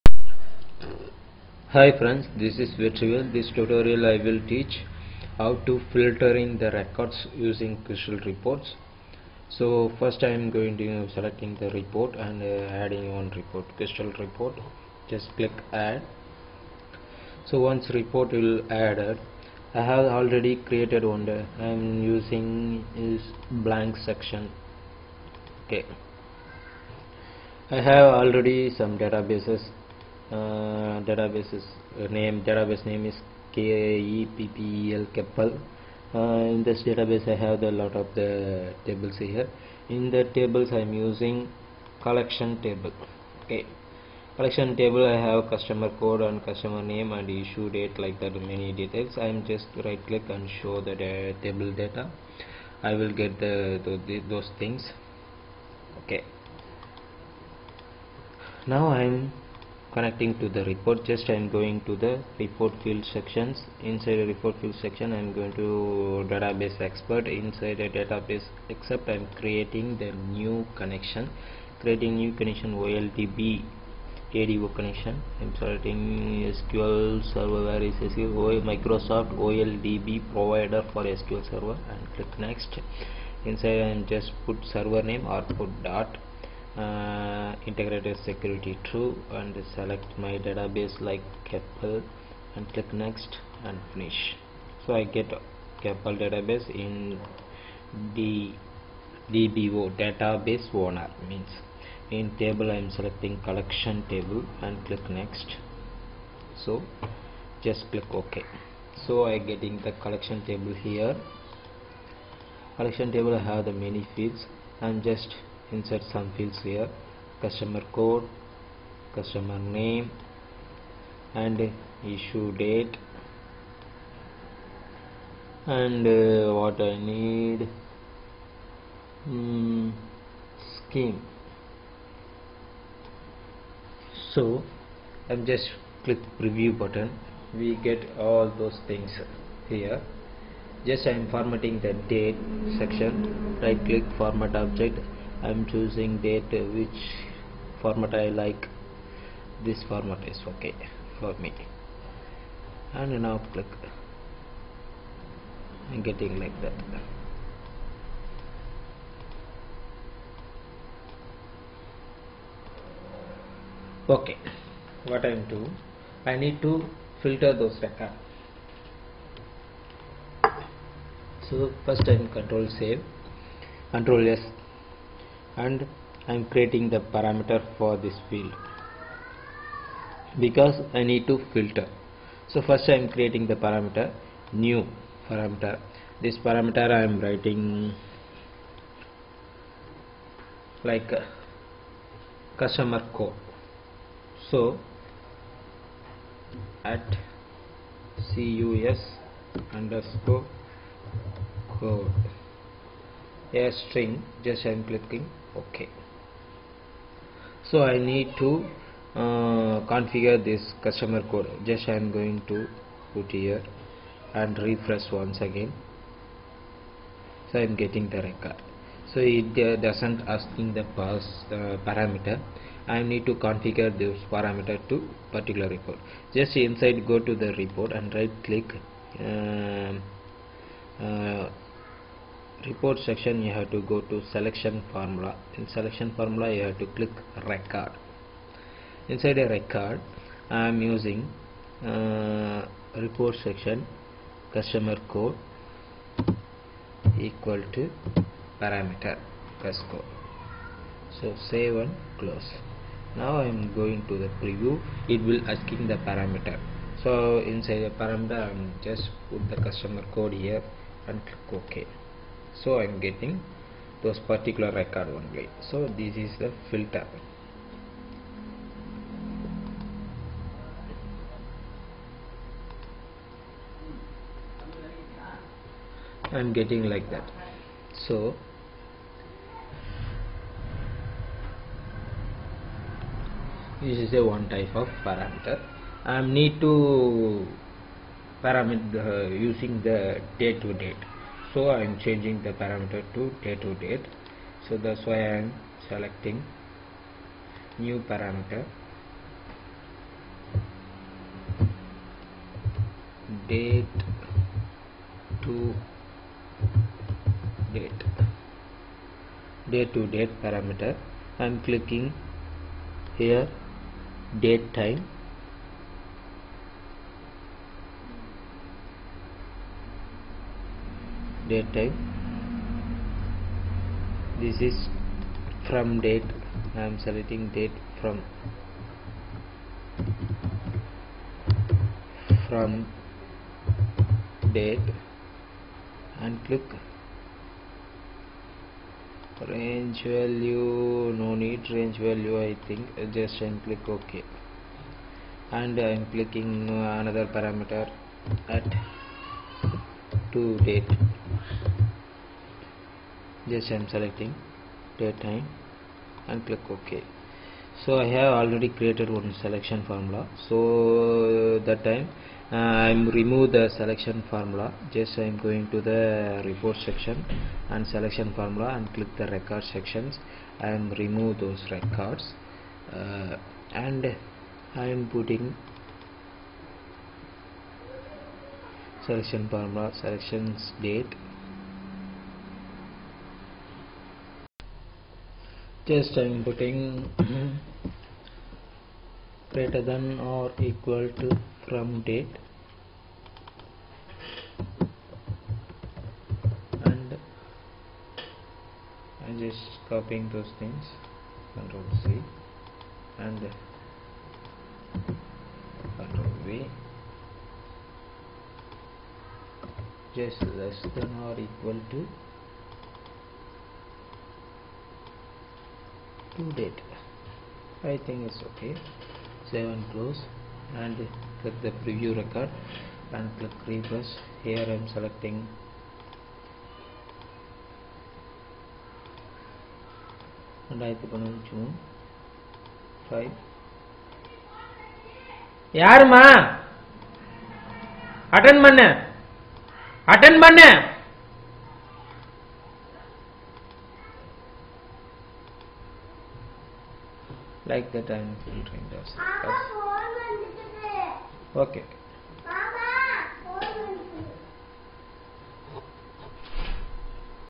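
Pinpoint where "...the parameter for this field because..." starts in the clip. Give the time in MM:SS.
02:56.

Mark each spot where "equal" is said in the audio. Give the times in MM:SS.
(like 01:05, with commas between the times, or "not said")
04:07, 06:30, 06:51.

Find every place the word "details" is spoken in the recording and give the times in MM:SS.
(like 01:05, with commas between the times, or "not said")
00:48.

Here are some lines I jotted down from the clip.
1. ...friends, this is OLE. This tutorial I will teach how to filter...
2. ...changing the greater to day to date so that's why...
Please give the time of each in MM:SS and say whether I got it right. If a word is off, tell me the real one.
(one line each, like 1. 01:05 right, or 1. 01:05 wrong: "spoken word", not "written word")
1. 00:01 wrong: "Vetrivel", not "OLE"
2. 04:51 wrong: "parameter", not "greater".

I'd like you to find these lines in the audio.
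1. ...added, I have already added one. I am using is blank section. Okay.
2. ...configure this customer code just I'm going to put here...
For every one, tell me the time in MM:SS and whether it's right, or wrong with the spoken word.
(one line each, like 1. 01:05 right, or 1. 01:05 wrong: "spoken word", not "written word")
1. 00:18 wrong: "created", not "added"
2. 03:29 right.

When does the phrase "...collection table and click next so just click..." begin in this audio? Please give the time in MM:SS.
01:43.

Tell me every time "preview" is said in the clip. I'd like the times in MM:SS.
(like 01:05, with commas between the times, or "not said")
02:16, 04:14, 07:01.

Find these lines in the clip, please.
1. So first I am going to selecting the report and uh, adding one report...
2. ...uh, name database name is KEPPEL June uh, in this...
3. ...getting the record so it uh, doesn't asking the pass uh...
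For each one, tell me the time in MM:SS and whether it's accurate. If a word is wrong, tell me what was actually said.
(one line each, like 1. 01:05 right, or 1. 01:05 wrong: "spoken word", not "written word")
1. 00:09 right
2. 00:31 wrong: "Keppel", not "June"
3. 03:37 right.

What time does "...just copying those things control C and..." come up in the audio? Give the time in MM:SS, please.
06:39.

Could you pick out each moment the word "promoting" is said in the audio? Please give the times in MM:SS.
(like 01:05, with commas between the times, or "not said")
not said.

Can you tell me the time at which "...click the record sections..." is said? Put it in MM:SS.
06:08.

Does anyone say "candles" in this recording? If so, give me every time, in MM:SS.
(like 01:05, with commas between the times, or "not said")
not said.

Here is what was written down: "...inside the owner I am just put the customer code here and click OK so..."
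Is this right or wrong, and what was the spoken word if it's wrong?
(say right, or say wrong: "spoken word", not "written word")
wrong: "parameter", not "owner".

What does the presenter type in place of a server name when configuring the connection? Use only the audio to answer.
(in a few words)
dot.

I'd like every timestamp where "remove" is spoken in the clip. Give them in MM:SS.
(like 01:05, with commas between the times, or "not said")
06:03, 06:10.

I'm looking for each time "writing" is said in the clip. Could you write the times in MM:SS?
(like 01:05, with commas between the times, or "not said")
03:07.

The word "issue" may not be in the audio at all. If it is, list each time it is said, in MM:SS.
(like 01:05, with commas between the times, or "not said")
00:47, 02:02.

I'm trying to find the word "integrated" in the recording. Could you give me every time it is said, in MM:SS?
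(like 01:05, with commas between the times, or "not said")
01:27.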